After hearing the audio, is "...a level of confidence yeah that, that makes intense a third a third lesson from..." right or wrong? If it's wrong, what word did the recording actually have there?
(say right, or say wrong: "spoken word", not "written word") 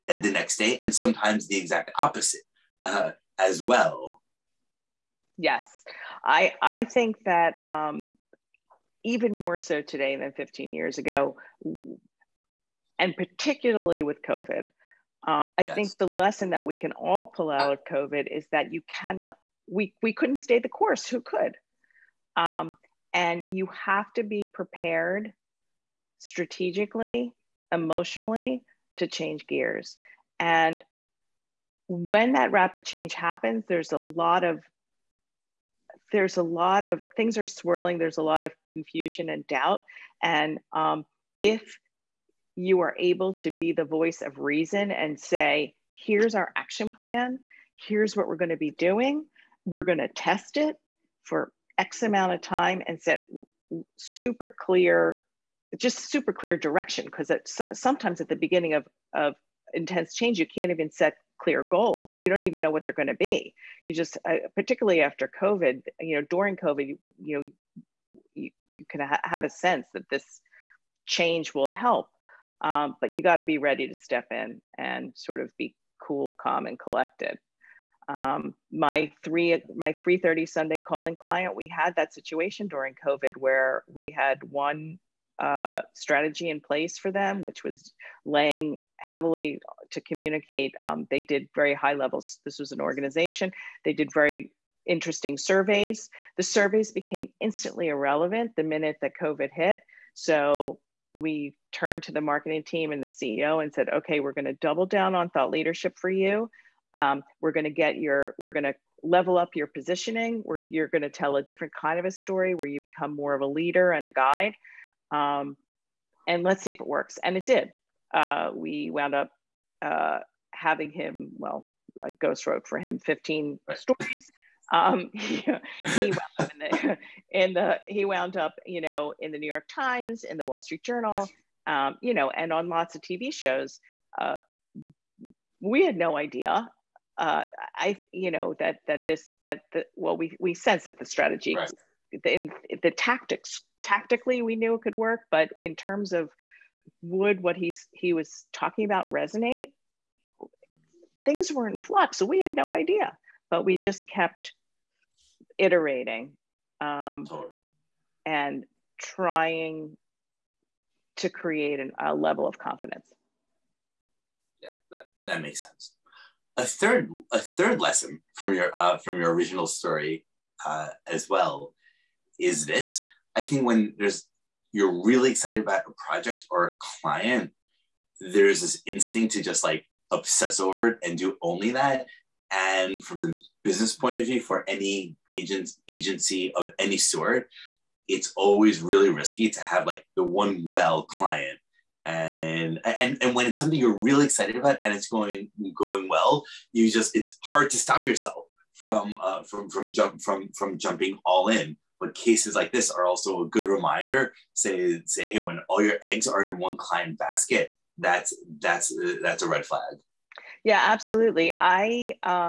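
wrong: "sense", not "intense".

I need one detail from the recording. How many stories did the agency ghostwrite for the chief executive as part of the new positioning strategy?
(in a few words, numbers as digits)
15.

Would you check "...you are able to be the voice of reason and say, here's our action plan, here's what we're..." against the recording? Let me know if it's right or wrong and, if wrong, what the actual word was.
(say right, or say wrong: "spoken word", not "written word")
right.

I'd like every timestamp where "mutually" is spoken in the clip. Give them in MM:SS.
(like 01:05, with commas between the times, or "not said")
not said.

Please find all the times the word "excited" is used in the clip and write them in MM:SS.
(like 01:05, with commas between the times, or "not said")
02:55, 03:14.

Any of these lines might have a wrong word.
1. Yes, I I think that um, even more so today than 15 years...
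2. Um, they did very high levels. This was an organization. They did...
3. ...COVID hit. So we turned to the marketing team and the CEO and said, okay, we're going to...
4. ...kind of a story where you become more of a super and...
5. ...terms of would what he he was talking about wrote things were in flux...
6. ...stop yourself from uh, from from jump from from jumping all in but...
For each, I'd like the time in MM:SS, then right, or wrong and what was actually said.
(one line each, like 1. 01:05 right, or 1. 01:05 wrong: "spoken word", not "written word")
1. 00:05 right
2. 01:30 right
3. 01:39 right
4. 01:51 wrong: "leader", not "super"
5. 02:25 wrong: "resonate", not "wrote"
6. 03:17 right.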